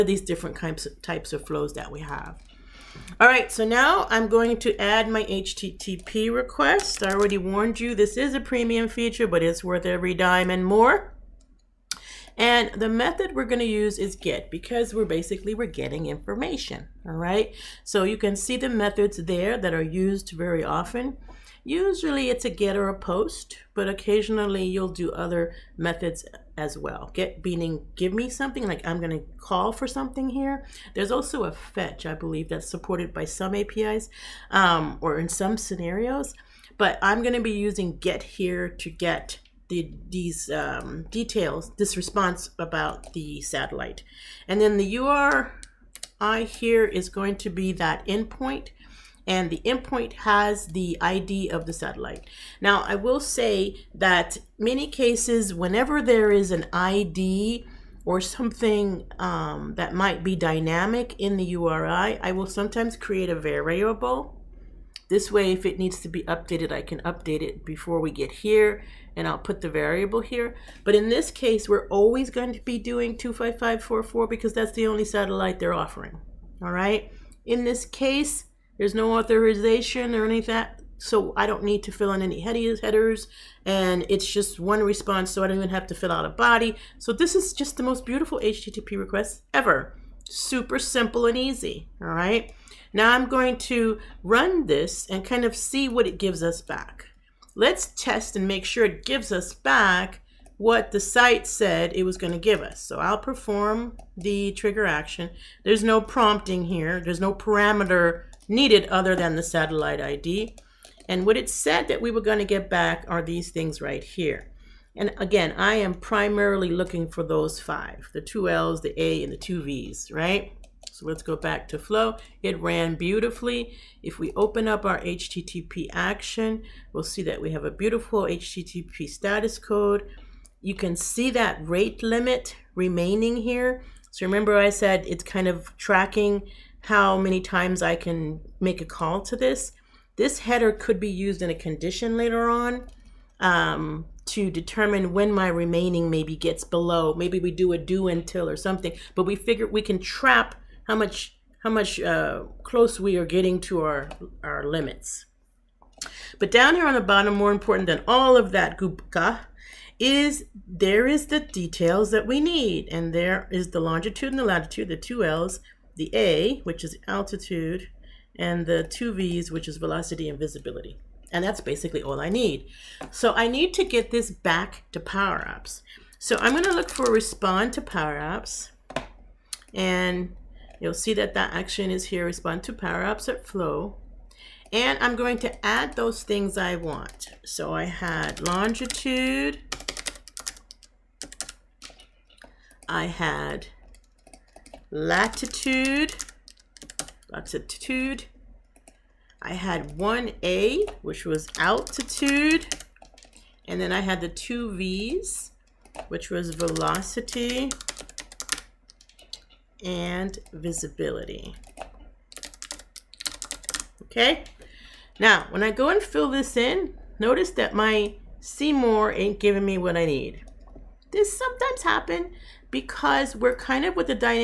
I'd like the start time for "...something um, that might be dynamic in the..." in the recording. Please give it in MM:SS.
00:58.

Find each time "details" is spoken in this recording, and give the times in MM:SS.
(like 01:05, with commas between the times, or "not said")
00:41, 02:41.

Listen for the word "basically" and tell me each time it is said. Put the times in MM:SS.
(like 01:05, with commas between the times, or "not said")
00:15, 02:51.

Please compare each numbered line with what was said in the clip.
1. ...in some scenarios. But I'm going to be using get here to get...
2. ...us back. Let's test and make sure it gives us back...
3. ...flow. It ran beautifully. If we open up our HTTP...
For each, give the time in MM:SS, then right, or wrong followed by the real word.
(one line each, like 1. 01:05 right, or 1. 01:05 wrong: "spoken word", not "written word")
1. 00:35 right
2. 01:36 right
3. 02:01 right.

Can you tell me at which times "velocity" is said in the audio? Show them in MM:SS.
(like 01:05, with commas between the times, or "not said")
02:49, 03:26.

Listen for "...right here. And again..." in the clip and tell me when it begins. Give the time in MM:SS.
01:53.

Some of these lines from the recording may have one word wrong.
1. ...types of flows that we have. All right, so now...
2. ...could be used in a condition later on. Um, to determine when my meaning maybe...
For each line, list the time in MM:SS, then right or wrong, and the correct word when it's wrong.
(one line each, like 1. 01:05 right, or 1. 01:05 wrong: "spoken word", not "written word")
1. 00:01 right
2. 02:20 wrong: "remaining", not "meaning".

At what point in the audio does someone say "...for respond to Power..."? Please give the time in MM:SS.
02:56.